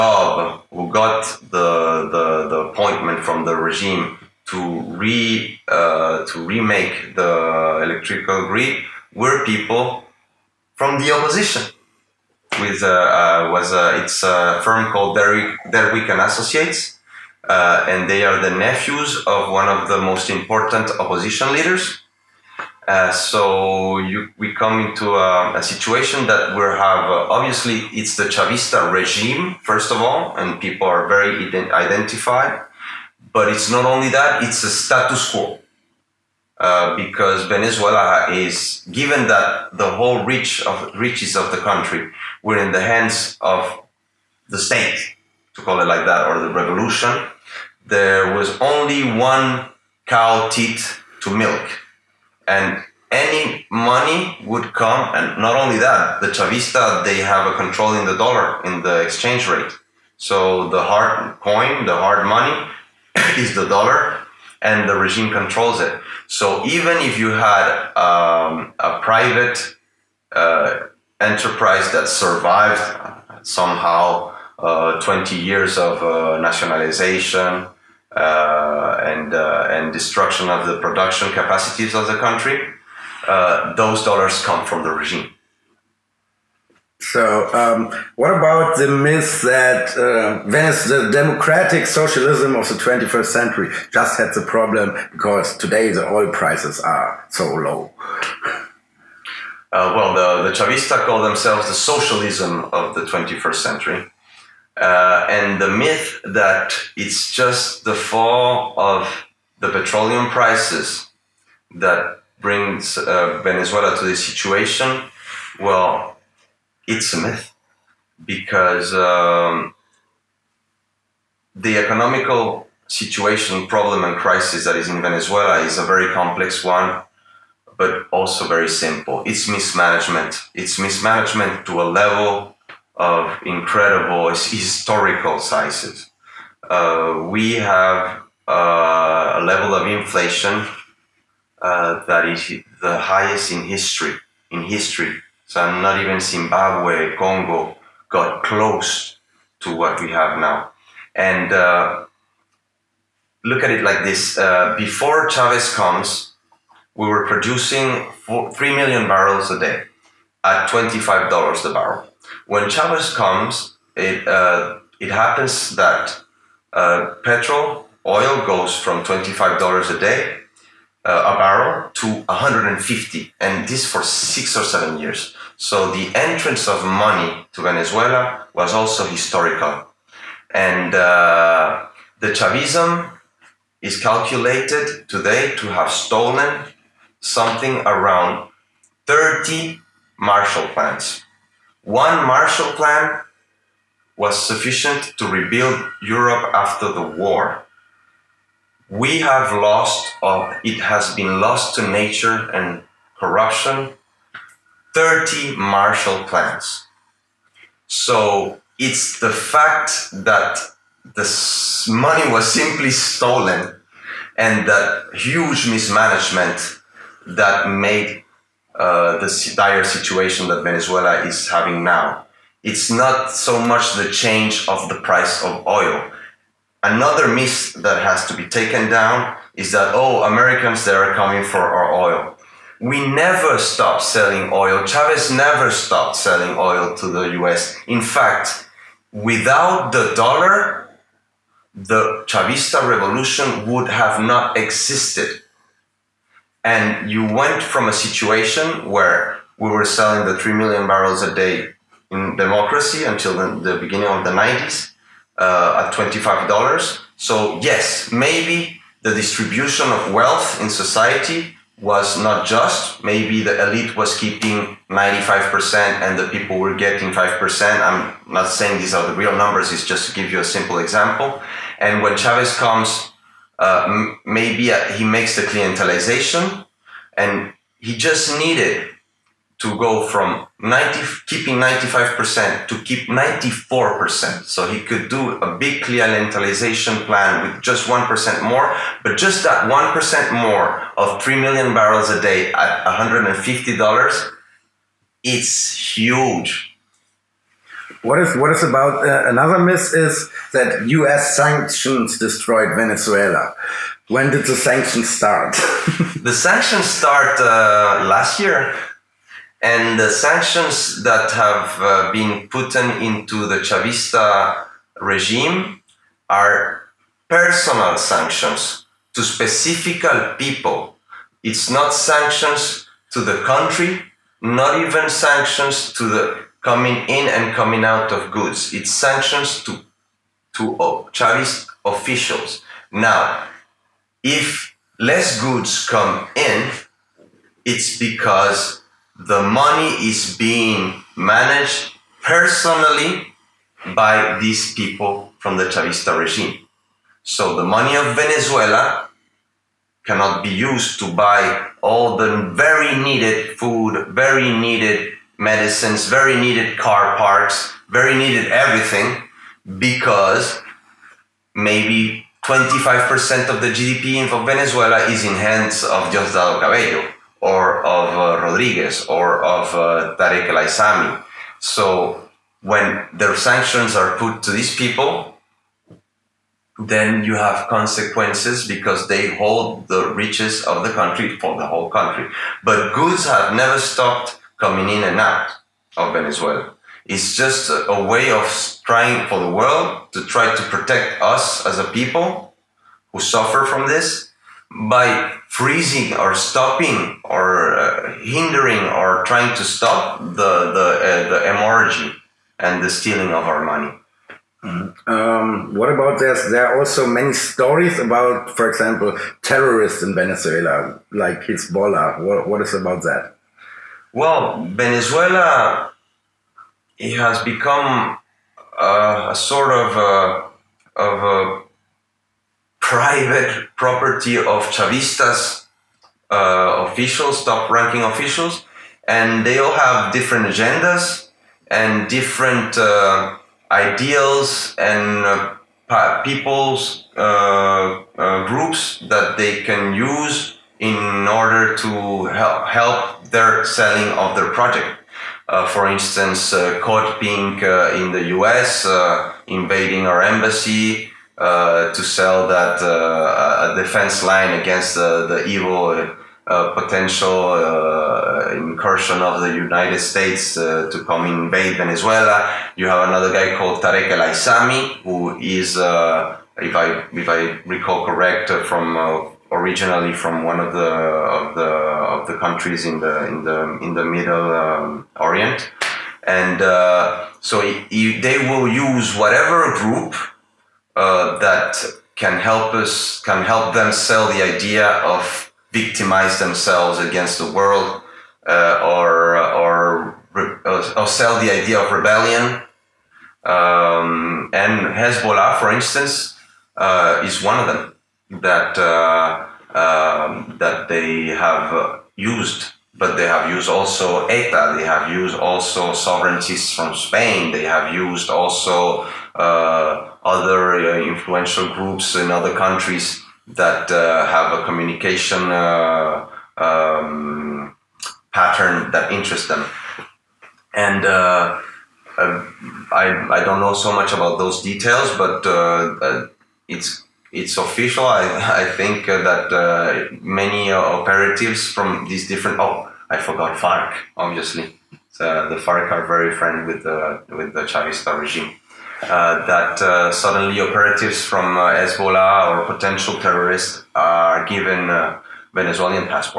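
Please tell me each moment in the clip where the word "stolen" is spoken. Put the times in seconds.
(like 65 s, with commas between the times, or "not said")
185 s, 212 s.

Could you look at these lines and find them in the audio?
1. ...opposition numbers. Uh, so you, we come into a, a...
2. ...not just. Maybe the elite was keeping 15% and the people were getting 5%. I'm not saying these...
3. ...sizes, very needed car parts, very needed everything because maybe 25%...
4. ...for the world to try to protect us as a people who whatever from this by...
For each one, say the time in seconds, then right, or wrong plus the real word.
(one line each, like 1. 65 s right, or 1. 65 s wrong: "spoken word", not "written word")
1. 20 s wrong: "leaders", not "numbers"
2. 262 s wrong: "95", not "15"
3. 355 s wrong: "medicines", not "sizes"
4. 389 s wrong: "suffer", not "whatever".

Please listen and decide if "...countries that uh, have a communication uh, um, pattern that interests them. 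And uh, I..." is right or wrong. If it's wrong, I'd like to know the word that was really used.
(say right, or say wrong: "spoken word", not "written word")
right.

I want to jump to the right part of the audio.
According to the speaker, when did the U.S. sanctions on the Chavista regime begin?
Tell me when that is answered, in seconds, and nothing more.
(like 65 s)
308 s.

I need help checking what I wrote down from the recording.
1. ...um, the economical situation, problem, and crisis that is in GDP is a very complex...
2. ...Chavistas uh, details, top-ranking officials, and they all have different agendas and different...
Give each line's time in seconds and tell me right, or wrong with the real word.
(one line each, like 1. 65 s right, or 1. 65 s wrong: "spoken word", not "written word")
1. 118 s wrong: "Venezuela", not "GDP"
2. 424 s wrong: "officials", not "details".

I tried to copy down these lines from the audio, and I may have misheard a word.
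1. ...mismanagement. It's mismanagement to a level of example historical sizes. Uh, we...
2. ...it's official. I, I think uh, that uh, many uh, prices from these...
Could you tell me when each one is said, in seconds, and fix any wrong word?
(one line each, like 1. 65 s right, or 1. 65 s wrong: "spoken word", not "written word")
1. 129 s wrong: "incredible", not "example"
2. 527 s wrong: "operatives", not "prices".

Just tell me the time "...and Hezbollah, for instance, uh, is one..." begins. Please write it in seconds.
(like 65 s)
494 s.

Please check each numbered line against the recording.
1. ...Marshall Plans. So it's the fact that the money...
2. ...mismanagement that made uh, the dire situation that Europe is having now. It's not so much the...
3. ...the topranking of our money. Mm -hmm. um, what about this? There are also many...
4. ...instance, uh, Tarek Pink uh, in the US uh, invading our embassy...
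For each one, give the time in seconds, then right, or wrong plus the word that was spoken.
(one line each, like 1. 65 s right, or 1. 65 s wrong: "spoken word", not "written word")
1. 205 s right
2. 215 s wrong: "Venezuela", not "Europe"
3. 402 s wrong: "stealing", not "topranking"
4. 445 s wrong: "Code", not "Tarek".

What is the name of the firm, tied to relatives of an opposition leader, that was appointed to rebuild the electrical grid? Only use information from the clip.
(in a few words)
Derwick and Associates.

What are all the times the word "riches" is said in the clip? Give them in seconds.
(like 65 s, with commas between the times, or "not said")
40 s, 380 s.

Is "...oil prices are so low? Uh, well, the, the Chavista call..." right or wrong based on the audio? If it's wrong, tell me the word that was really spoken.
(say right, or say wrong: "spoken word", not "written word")
right.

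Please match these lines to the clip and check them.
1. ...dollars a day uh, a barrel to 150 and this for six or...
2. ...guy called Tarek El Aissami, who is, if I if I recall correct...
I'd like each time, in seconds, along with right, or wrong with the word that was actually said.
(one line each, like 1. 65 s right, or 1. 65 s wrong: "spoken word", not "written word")
1. 169 s right
2. 463 s right.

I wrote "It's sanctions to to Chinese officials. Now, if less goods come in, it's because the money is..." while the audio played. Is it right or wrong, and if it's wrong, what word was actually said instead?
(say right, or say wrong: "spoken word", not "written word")
right.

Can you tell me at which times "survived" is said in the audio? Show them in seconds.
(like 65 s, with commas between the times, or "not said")
72 s.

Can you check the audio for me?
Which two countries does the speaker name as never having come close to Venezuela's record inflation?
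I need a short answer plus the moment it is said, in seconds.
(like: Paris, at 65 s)
Zimbabwe, Congo, at 146 s.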